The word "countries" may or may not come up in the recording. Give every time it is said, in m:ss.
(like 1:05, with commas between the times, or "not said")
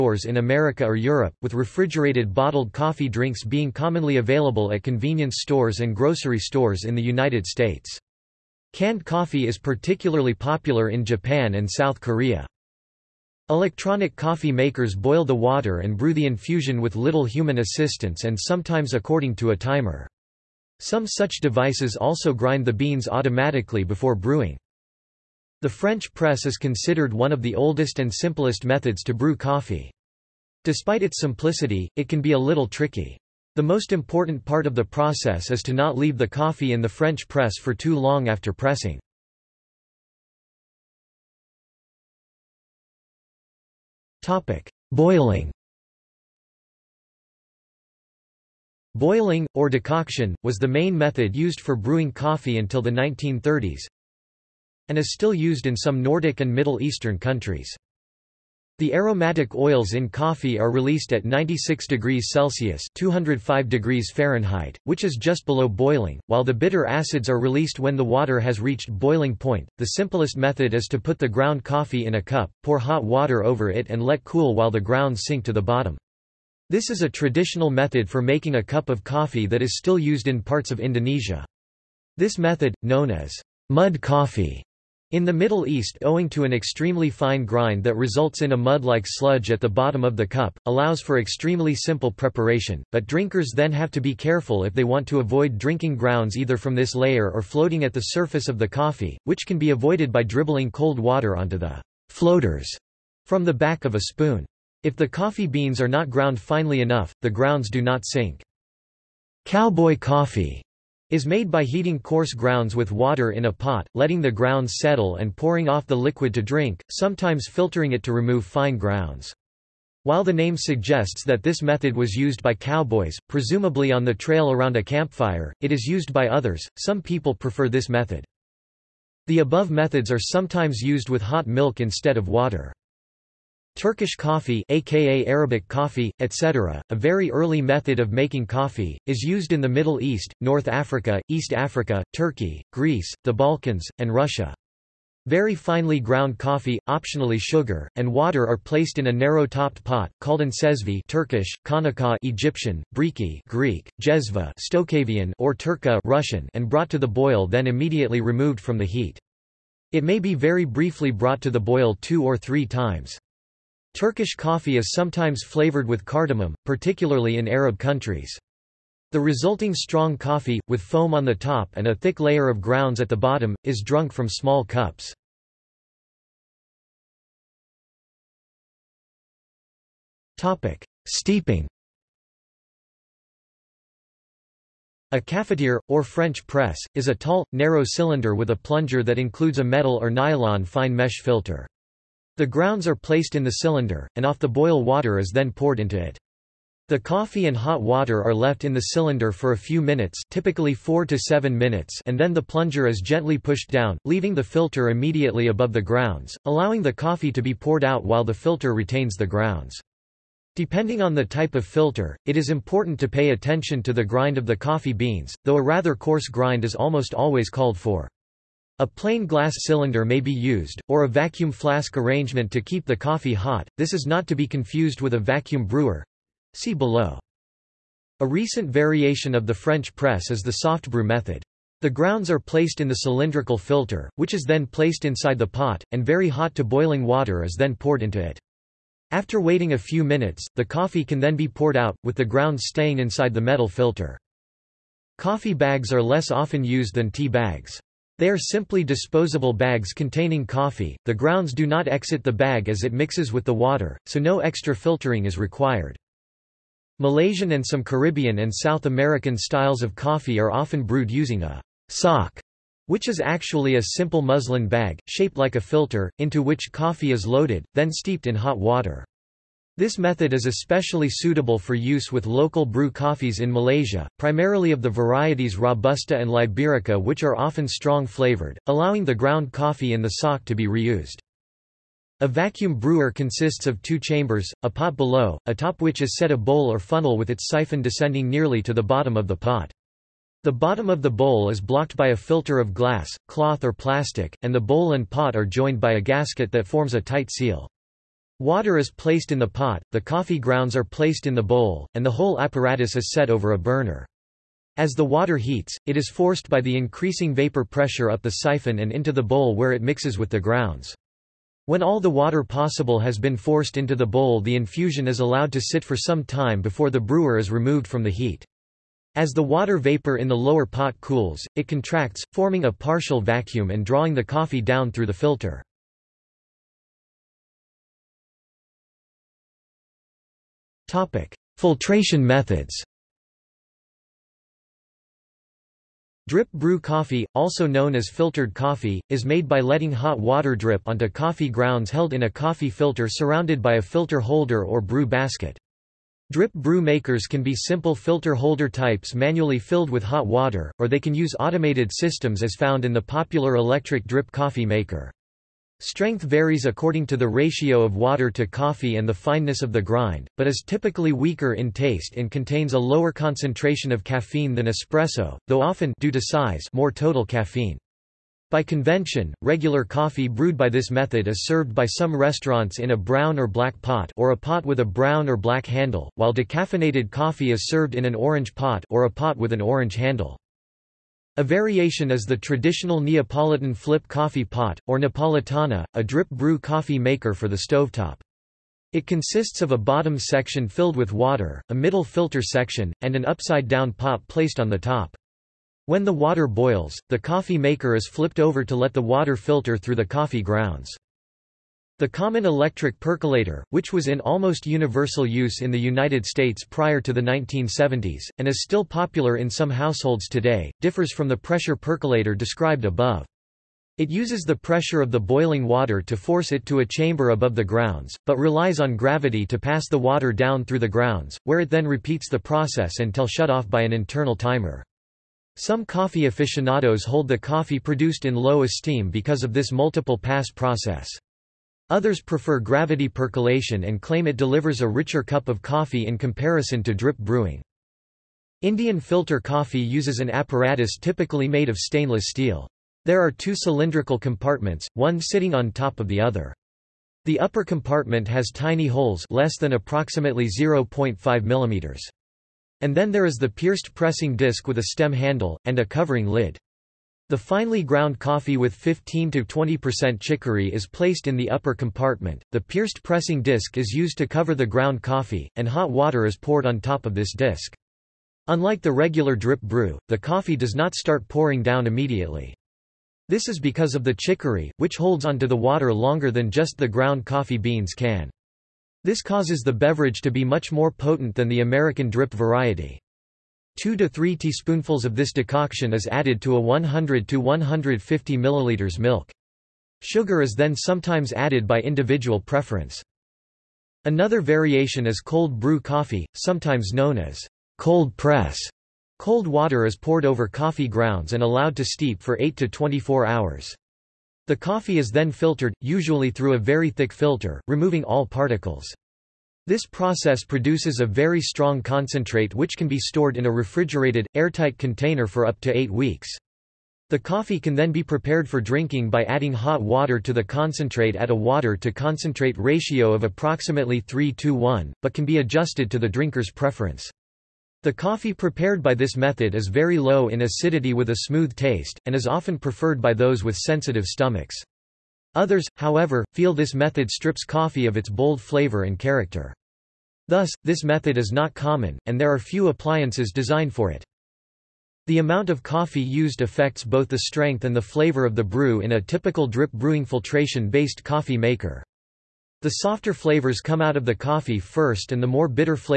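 0:57, 2:47.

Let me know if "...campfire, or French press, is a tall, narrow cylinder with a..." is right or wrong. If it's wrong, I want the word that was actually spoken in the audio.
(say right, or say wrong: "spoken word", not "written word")
wrong: "cafetiere", not "campfire".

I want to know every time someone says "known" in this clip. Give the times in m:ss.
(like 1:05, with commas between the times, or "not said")
1:22, 5:37, 8:16.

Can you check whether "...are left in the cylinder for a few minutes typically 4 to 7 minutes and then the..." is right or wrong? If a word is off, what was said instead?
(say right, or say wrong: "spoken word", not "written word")
right.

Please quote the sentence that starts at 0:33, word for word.
The most important part of the process is to not leave the coffee in the French press for too long after pressing.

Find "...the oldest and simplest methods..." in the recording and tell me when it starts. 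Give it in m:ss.
0:27.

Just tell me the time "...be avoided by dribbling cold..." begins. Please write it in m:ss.
1:39.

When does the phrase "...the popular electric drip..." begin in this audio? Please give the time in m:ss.
5:52.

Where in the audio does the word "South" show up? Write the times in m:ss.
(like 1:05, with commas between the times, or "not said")
0:11, 4:18.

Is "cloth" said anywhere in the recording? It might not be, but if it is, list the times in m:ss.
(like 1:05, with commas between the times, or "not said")
4:53.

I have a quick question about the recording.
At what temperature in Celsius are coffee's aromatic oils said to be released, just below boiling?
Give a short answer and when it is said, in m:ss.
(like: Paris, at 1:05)
96 degrees, at 1:01.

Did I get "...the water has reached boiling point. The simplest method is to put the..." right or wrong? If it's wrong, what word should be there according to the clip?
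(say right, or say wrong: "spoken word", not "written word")
right.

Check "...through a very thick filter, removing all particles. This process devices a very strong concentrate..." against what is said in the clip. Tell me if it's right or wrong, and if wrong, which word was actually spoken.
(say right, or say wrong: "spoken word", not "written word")
wrong: "produces", not "devices".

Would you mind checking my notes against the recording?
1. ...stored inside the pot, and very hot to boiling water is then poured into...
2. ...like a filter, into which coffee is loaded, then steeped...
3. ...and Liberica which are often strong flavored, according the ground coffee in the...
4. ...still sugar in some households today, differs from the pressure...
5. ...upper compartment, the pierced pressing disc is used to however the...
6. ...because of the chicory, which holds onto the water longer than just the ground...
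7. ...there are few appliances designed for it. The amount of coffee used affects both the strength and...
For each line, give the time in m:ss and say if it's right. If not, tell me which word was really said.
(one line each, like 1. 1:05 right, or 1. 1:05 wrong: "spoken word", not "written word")
1. 3:54 wrong: "placed", not "stored"
2. 4:25 right
3. 4:36 wrong: "allowing", not "according"
4. 6:48 wrong: "popular", not "sugar"
5. 7:41 wrong: "cover", not "however"
6. 7:53 right
7. 9:02 right.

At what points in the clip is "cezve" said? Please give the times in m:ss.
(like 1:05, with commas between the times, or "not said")
2:30.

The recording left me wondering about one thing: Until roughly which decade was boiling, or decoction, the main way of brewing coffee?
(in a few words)
1930s.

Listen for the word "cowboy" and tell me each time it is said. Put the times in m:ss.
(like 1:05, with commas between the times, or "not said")
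1:49, 2:02.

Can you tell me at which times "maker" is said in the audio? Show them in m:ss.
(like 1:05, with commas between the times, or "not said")
0:14, 5:46, 5:54, 6:26, 6:37, 9:11.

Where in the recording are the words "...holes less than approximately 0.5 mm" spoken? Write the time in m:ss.
7:28.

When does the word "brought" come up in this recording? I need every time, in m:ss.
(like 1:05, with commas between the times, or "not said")
2:36, 2:41.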